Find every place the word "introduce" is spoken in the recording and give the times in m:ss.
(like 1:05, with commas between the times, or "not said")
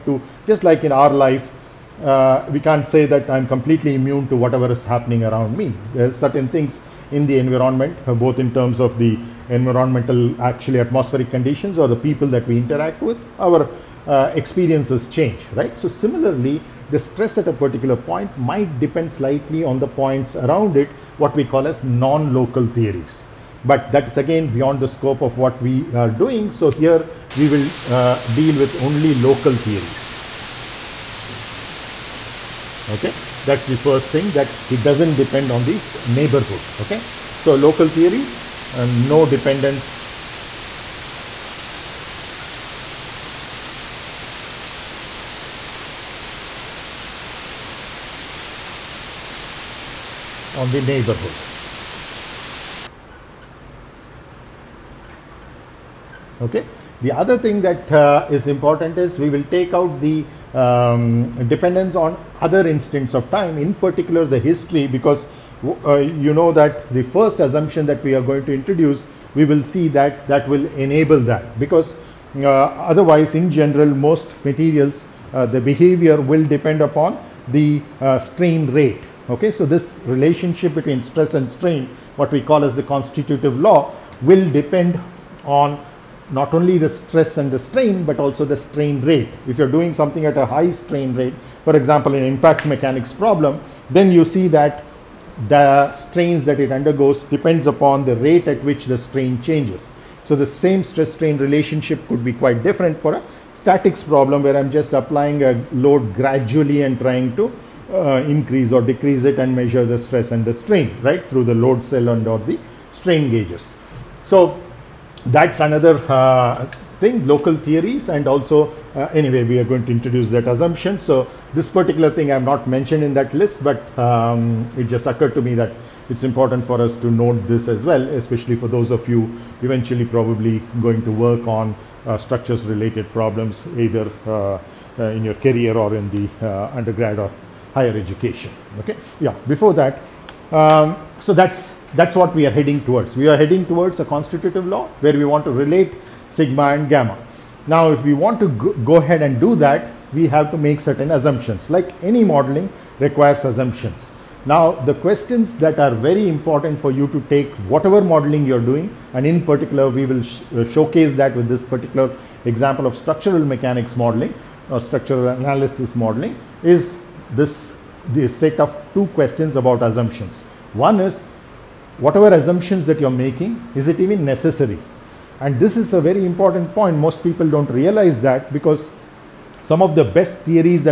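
1:08, 1:59.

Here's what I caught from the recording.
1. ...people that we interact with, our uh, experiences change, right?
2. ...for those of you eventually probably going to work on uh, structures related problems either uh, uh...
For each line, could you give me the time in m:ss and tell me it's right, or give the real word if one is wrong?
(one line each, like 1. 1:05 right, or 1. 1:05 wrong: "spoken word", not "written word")
1. 0:11 right
2. 2:08 right.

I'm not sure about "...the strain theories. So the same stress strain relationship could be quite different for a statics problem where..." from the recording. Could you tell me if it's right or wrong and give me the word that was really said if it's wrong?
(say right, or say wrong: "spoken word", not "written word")
wrong: "changes", not "theories".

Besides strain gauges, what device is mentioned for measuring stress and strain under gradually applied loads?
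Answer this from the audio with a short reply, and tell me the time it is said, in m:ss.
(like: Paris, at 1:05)
Load cell, at 1:51.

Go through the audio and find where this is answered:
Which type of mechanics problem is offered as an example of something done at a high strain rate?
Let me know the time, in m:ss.
1:32.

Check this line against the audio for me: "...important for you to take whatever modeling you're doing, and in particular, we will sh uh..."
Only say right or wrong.
right.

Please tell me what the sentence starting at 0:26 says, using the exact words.
So here we will uh, deal with only local theories.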